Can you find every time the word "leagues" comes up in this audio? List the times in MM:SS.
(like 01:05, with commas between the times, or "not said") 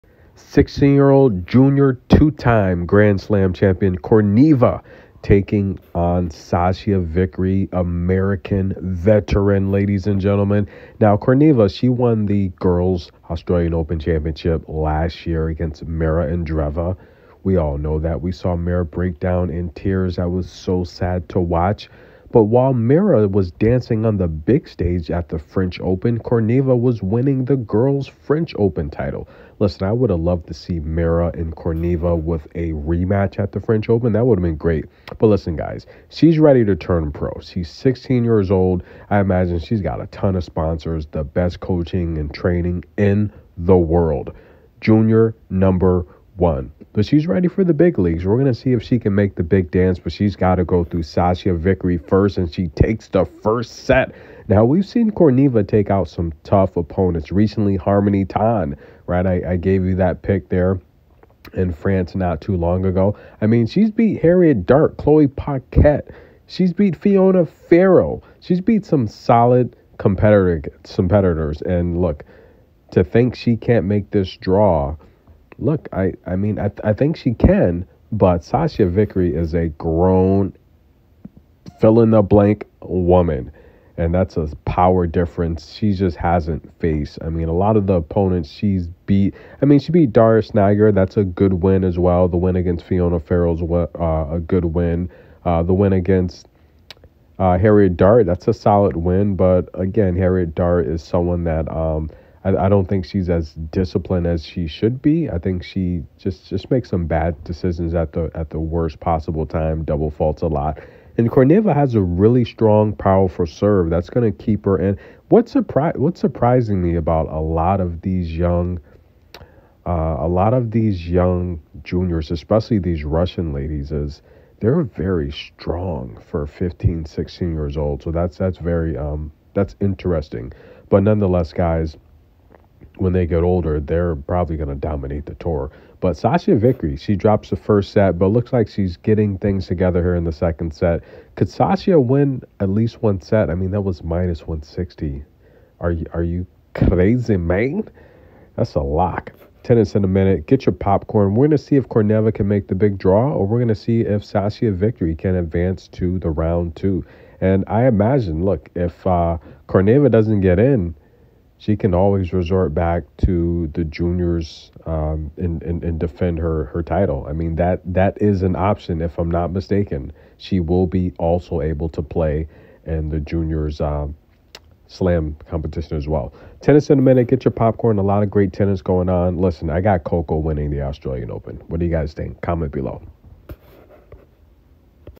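00:47.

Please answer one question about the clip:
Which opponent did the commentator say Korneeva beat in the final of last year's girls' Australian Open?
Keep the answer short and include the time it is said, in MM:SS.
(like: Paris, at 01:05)
Mira Andreeva, at 00:15.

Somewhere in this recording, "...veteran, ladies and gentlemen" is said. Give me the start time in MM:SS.
00:08.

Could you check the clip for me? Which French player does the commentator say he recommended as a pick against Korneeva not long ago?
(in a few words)
Harmony Tan.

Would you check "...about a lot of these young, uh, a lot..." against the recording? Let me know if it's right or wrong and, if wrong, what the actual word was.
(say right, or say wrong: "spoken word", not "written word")
right.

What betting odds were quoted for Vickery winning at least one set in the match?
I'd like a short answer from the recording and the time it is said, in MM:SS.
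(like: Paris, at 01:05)
-160, at 02:24.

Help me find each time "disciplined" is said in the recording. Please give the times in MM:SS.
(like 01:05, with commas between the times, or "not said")
01:43.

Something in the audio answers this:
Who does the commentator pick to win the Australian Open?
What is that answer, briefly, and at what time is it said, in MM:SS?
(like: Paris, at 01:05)
Coco, at 03:00.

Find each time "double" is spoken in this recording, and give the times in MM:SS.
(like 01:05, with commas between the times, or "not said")
01:49.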